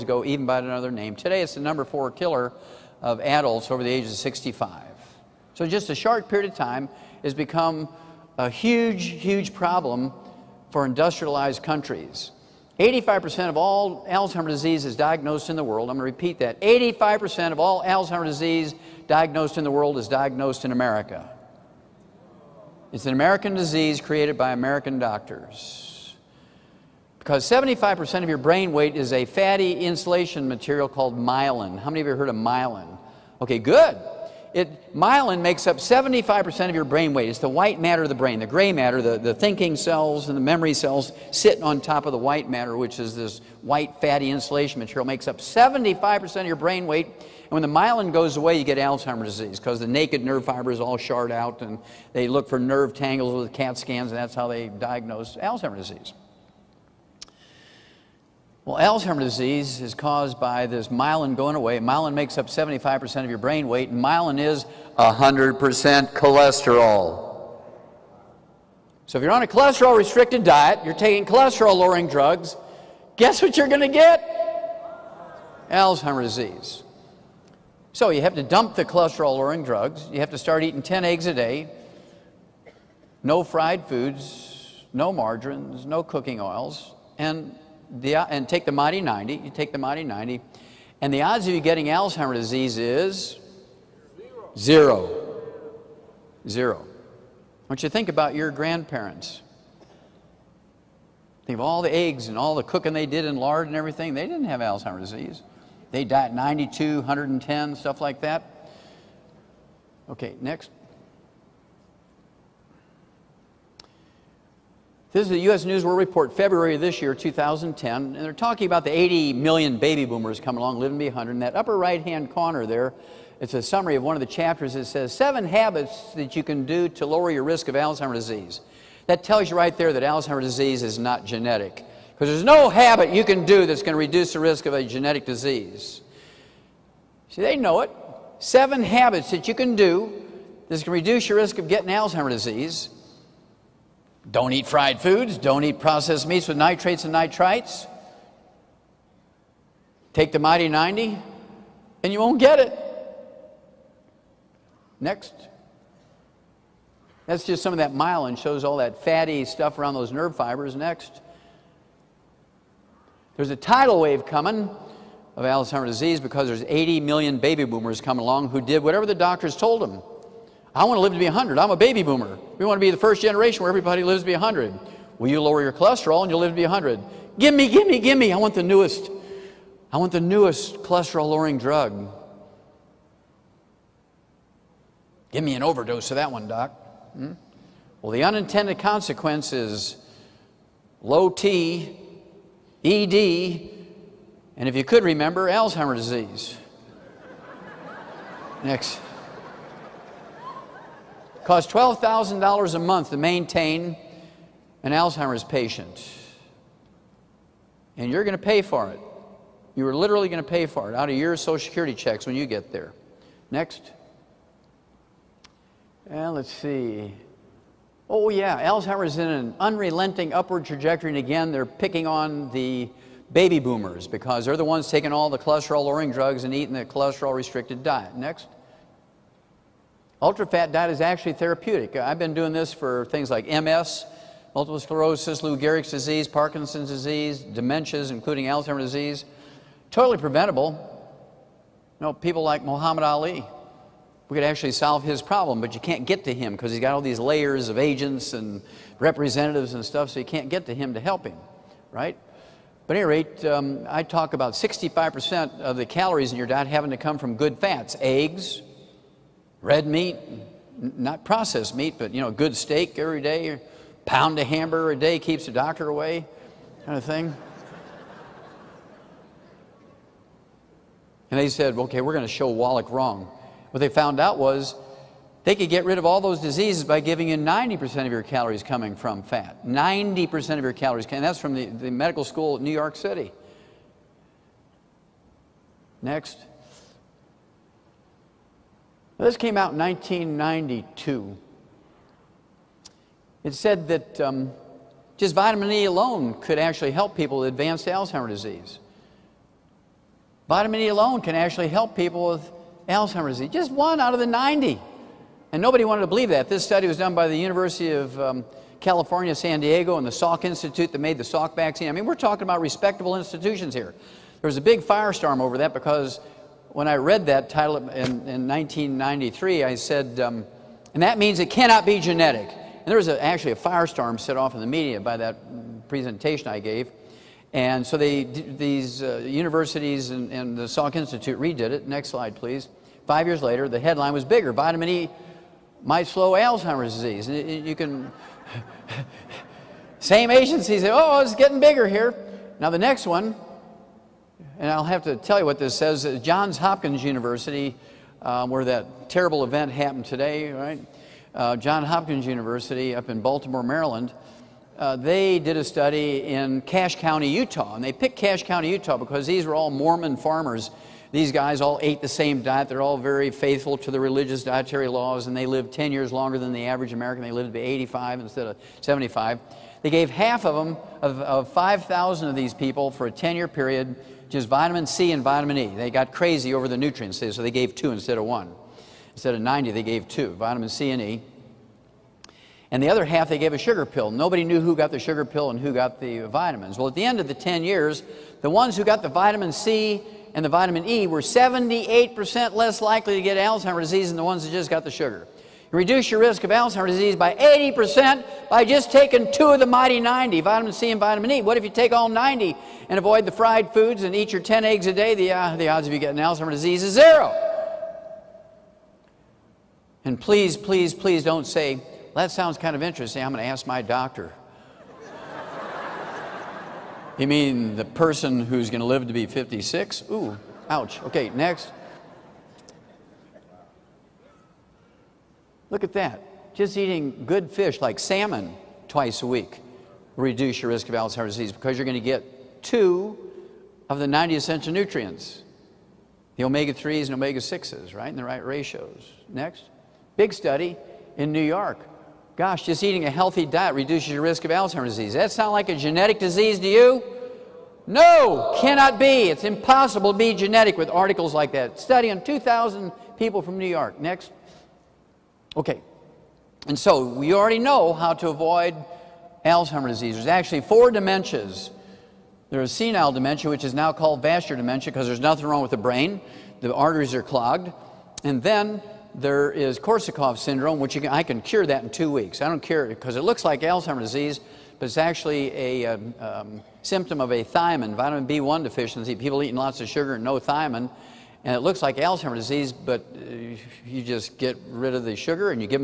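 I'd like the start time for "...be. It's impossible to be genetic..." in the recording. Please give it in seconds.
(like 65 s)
449 s.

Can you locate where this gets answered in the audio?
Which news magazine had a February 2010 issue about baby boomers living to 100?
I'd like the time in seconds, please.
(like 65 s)
115 s.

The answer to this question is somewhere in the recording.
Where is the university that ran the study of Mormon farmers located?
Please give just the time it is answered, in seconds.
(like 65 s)
353 s.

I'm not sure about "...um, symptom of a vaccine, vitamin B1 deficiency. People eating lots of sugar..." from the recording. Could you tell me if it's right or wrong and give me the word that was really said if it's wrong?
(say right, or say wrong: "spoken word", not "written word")
wrong: "thiamine", not "vaccine".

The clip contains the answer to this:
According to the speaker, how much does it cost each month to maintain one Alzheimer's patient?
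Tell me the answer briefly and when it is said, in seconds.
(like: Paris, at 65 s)
$12,000, at 201 s.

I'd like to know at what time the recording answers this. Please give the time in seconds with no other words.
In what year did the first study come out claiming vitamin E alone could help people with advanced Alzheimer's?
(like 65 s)
289 s.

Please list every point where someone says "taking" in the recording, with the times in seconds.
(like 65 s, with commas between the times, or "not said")
70 s, 224 s, 398 s.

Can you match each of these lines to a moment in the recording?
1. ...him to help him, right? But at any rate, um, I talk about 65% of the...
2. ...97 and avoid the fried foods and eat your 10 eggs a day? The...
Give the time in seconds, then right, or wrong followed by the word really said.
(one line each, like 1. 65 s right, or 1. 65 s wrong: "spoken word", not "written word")
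1. 250 s right
2. 402 s wrong: "90", not "97".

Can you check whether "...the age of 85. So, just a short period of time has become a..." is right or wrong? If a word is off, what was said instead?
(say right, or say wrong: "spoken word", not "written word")
wrong: "65", not "85".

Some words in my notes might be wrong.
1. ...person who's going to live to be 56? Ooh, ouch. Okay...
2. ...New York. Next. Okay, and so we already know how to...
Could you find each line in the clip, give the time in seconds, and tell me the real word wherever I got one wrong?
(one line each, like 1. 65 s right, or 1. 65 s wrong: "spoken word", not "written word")
1. 417 s right
2. 453 s right.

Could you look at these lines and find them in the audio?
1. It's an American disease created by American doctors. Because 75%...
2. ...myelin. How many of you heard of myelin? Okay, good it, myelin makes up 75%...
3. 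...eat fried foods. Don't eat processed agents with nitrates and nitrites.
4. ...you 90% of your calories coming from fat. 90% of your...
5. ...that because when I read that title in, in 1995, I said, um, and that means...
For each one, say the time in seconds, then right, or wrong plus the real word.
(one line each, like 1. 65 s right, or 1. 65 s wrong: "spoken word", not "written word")
1. 22 s right
2. 31 s right
3. 144 s wrong: "meats", not "agents"
4. 277 s right
5. 315 s wrong: "1993", not "1995".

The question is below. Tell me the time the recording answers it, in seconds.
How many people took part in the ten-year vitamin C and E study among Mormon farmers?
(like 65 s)
371 s.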